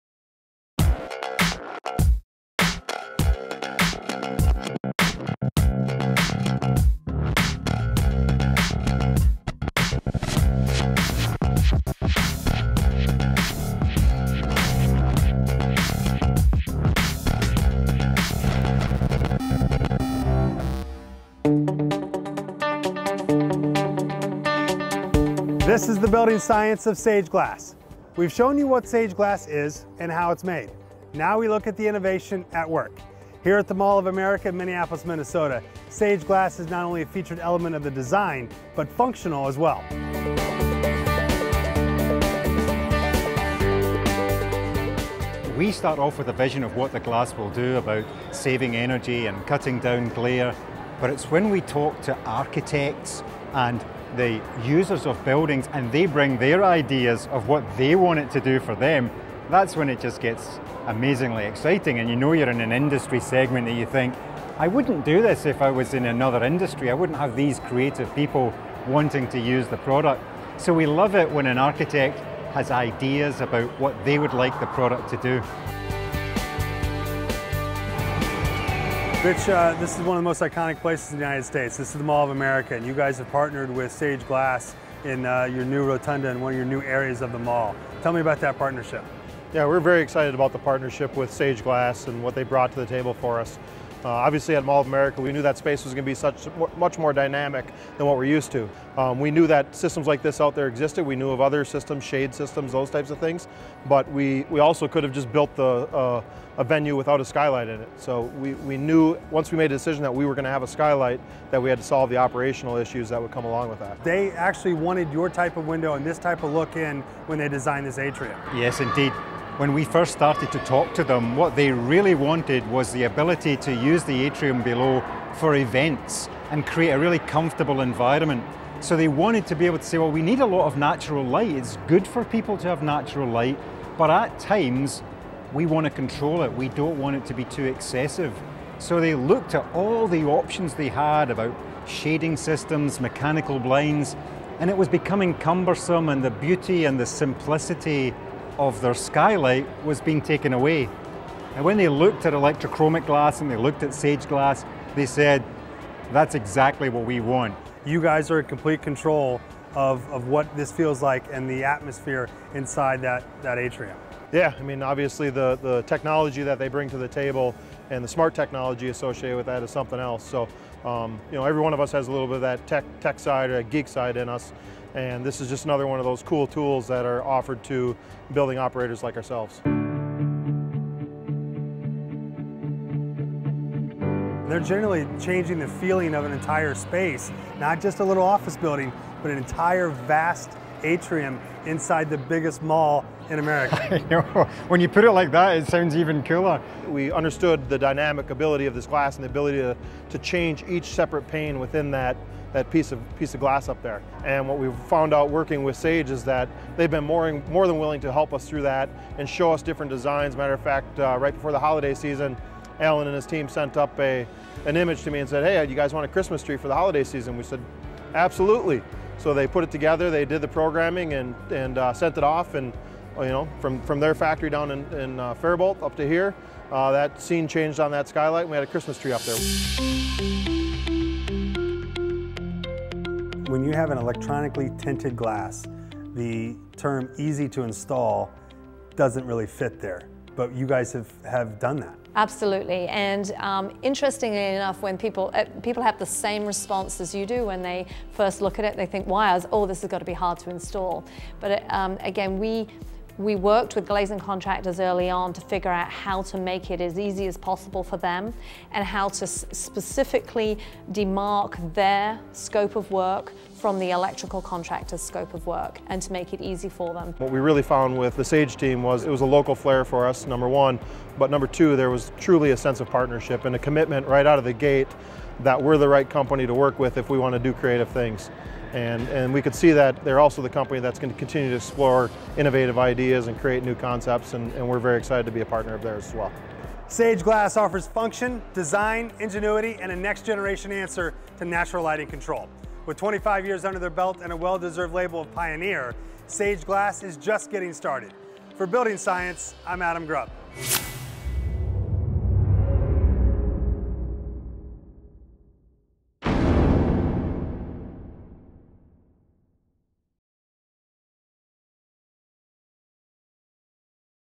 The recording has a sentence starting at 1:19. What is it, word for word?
Rich, uh, this is one of the most iconic places in the United States.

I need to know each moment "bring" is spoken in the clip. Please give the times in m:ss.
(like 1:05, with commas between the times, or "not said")
0:56, 2:46.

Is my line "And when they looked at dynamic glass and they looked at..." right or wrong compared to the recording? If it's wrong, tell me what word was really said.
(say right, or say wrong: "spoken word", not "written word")
wrong: "electrochromic", not "dynamic".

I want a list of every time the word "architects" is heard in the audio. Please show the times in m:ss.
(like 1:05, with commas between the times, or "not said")
0:52, 1:11.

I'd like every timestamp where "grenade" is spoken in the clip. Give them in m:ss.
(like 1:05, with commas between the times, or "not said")
not said.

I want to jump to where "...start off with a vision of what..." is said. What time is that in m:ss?
0:45.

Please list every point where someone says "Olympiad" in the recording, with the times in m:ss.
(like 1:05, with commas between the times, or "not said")
not said.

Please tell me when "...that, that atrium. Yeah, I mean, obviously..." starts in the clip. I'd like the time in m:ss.
2:43.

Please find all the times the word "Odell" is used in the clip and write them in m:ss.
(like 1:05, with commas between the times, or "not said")
not said.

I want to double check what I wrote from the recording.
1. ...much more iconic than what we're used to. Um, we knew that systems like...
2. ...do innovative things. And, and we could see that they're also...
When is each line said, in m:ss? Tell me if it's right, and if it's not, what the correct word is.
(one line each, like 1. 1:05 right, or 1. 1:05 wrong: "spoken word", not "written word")
1. 1:36 wrong: "dynamic", not "iconic"
2. 4:37 wrong: "creative", not "innovative".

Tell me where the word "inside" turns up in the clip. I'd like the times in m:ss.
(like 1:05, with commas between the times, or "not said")
2:42, 3:11.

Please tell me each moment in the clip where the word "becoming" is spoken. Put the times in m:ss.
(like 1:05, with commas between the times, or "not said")
2:24.